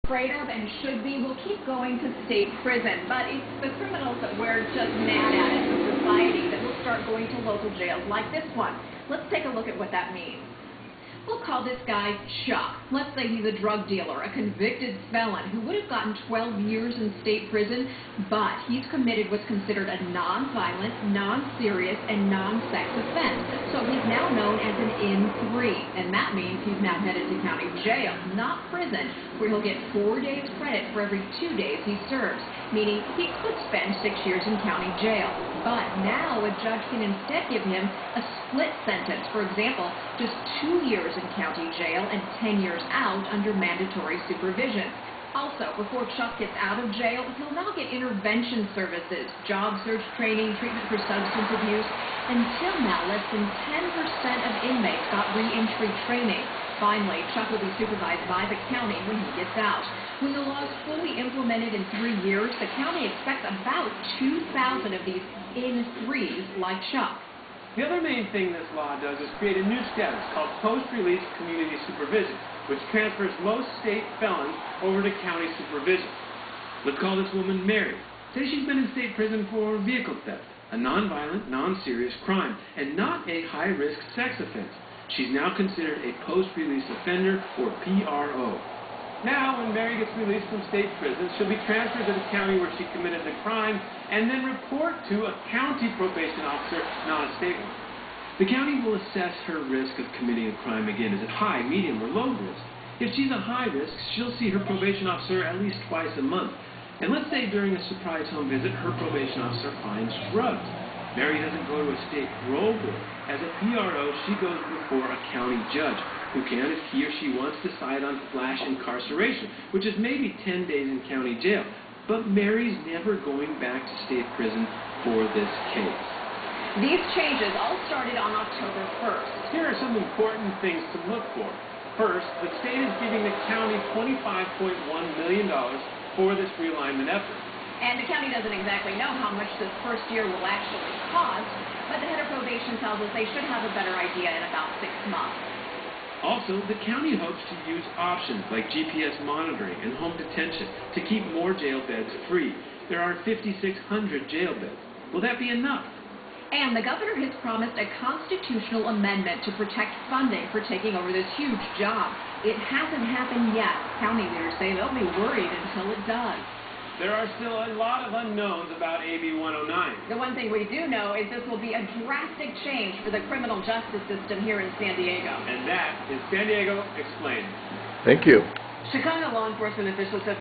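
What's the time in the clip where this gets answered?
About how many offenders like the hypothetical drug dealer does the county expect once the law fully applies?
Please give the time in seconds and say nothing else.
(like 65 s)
64 s.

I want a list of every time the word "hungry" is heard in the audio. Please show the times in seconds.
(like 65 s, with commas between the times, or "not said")
not said.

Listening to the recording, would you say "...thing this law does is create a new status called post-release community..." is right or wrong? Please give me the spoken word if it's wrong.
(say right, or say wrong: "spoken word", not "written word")
right.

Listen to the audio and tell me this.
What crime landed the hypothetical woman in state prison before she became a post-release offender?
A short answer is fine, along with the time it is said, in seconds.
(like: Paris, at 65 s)
Vehicle theft, at 79 s.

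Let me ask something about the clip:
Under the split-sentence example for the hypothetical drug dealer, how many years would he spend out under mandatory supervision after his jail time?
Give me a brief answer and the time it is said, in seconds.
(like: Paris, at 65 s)
10 years, at 42 s.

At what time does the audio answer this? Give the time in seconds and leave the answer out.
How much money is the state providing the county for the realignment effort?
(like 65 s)
133 s.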